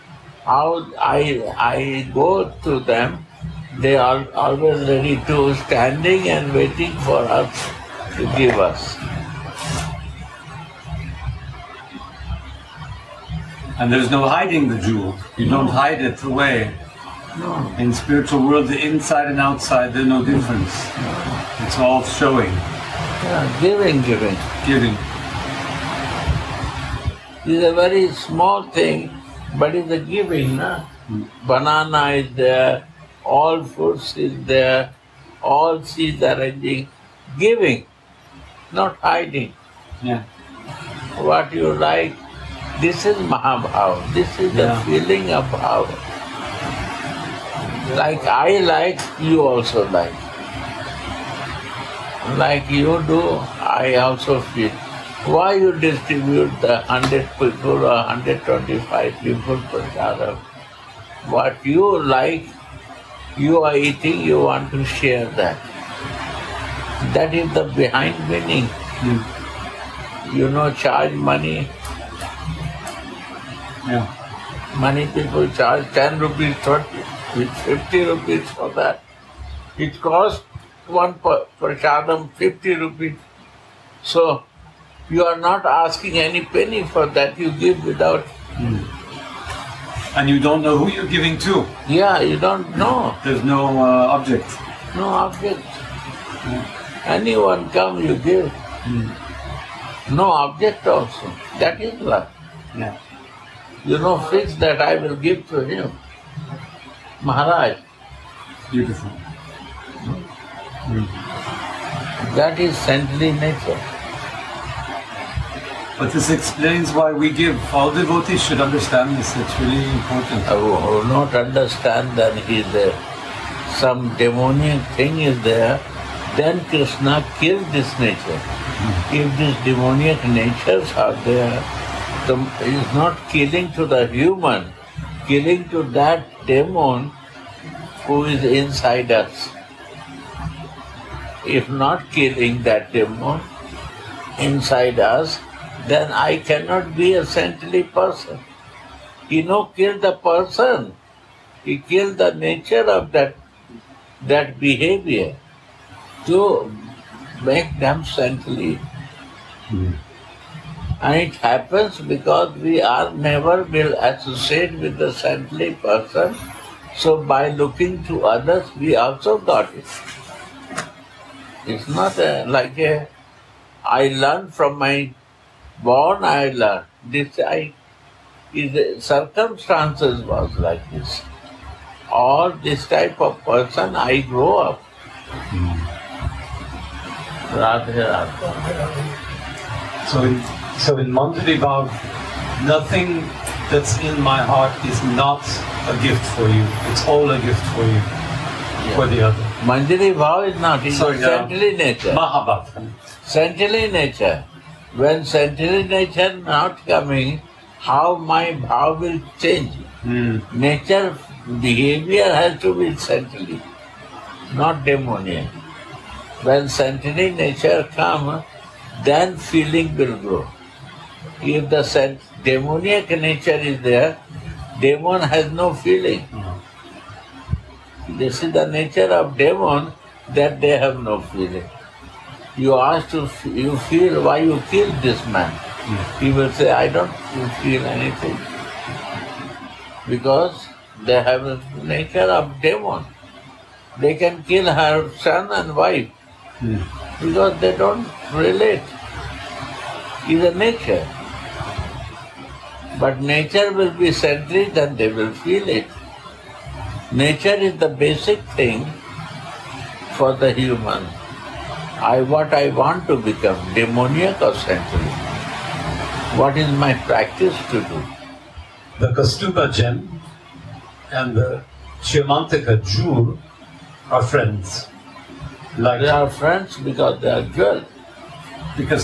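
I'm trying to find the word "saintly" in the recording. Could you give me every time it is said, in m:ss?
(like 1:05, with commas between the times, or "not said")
1:52, 2:27, 2:38, 2:45, 4:24.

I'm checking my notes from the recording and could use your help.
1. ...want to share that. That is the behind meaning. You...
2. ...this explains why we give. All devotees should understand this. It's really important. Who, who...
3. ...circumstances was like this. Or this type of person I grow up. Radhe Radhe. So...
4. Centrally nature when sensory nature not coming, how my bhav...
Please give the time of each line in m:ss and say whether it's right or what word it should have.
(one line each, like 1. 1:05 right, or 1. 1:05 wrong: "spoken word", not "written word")
1. 1:04 right
2. 1:56 right
3. 2:59 right
4. 3:23 right.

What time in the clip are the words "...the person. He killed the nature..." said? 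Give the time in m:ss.
2:30.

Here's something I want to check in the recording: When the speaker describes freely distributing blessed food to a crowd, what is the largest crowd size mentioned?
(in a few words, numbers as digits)
125.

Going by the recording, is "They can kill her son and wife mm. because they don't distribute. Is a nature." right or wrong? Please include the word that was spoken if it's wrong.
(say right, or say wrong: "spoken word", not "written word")
wrong: "relate", not "distribute".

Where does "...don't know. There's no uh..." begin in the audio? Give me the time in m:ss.
1:32.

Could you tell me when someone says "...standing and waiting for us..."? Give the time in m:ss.
0:05.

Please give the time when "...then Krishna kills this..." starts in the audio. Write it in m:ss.
2:06.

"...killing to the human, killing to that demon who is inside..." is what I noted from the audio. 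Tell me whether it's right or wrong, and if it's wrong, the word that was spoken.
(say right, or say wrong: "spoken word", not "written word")
right.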